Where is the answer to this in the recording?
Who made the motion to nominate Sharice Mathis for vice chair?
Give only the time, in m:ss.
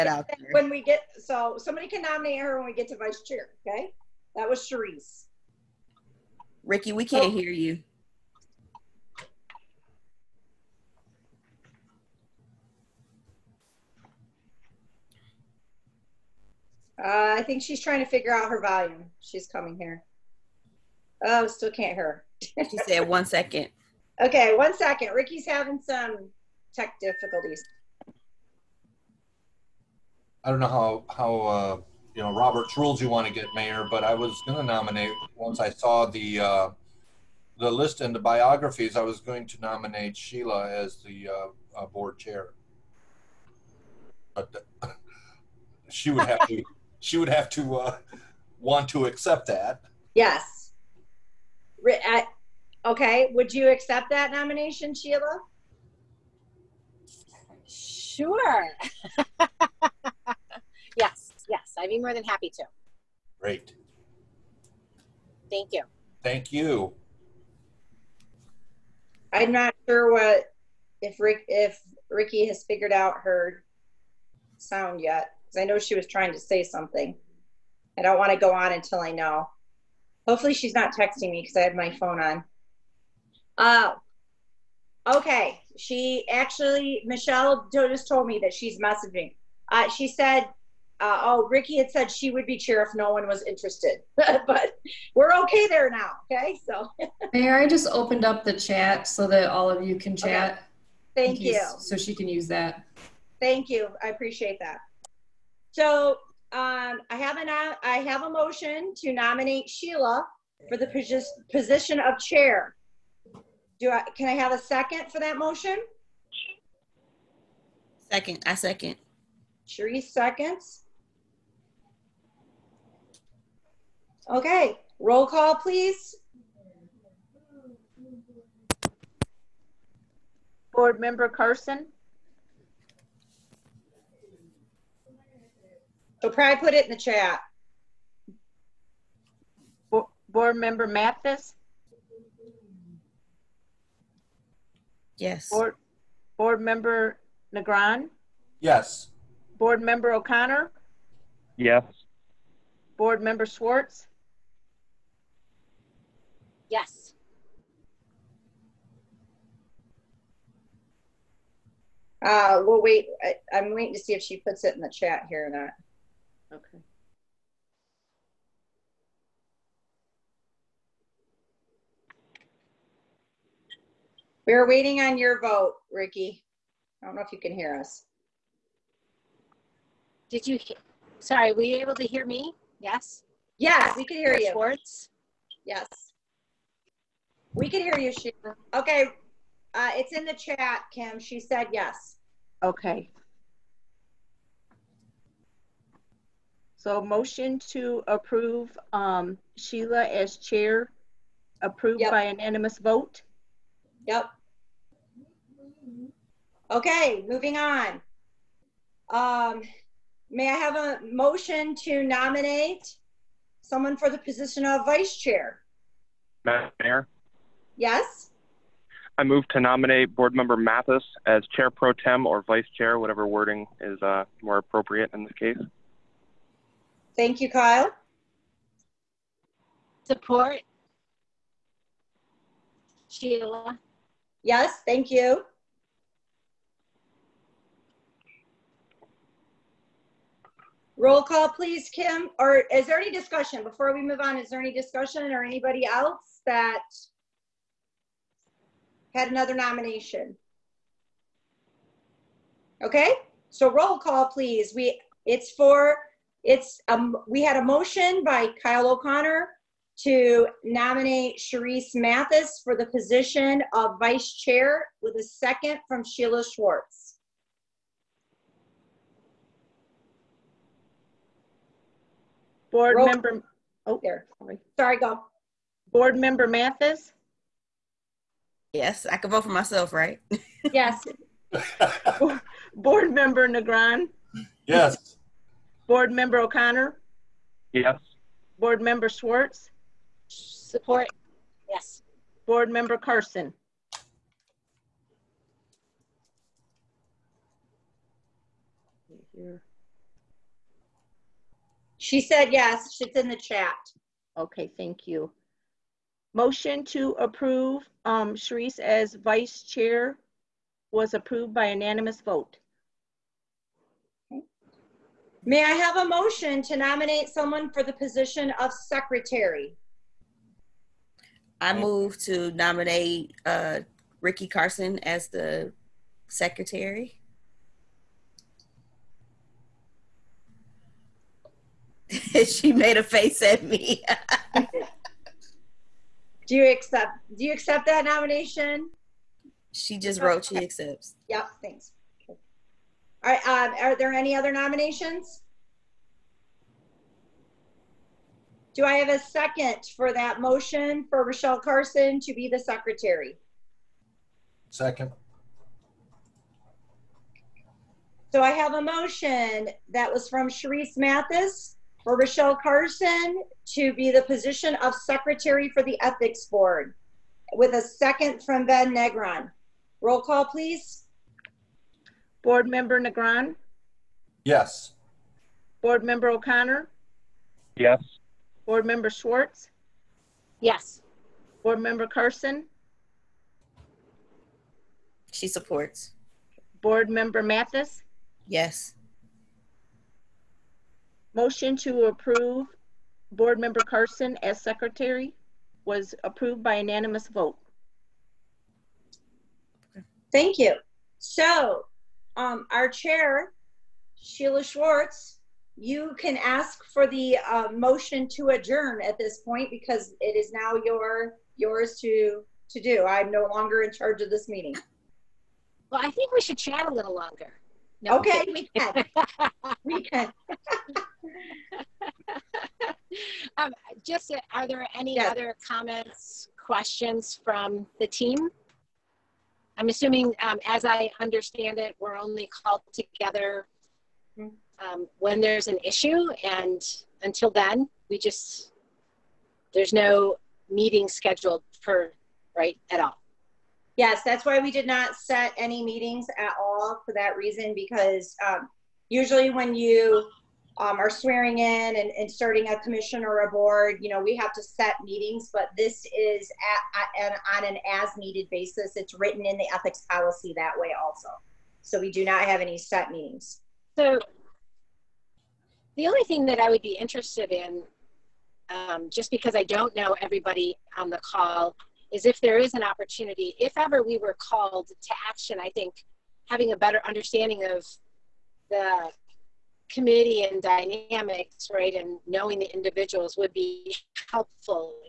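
4:18.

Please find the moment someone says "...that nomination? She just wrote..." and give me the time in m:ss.
5:37.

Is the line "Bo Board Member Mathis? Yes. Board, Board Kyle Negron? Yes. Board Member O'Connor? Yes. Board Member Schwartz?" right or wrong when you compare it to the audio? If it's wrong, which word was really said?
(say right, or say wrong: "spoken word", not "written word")
wrong: "Member", not "Kyle".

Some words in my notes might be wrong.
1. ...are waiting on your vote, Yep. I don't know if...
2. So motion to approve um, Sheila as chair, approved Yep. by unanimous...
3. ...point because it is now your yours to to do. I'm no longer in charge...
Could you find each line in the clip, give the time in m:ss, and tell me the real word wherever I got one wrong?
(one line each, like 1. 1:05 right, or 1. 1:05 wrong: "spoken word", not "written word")
1. 2:54 wrong: "Ricky", not "Yep"
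2. 3:16 right
3. 6:49 right.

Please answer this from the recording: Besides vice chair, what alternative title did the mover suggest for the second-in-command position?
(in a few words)
Chair Pro Tem.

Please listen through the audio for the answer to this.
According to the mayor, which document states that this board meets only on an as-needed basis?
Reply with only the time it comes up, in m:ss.
7:39.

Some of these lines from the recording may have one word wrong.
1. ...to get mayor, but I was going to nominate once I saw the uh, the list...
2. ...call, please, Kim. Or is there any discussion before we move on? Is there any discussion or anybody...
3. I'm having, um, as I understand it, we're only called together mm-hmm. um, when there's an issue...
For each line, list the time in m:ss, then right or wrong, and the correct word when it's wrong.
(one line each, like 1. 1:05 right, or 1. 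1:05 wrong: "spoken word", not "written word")
1. 0:33 right
2. 4:01 right
3. 7:09 wrong: "assuming", not "having".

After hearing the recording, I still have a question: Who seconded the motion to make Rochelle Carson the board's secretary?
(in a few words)
Ben Negron.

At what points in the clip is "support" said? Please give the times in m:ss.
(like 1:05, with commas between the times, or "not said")
3:50, 4:50, 6:25.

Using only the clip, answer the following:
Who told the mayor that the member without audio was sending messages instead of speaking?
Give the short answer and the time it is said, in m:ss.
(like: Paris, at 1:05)
Michelle, at 1:27.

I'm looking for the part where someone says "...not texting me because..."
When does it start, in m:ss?
1:20.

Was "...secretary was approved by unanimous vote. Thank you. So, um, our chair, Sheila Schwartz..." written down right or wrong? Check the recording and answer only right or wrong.
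right.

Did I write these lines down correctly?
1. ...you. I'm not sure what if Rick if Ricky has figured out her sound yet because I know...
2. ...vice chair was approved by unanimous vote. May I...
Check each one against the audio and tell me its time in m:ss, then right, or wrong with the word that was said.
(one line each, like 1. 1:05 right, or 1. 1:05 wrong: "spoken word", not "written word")
1. 1:06 right
2. 5:09 right.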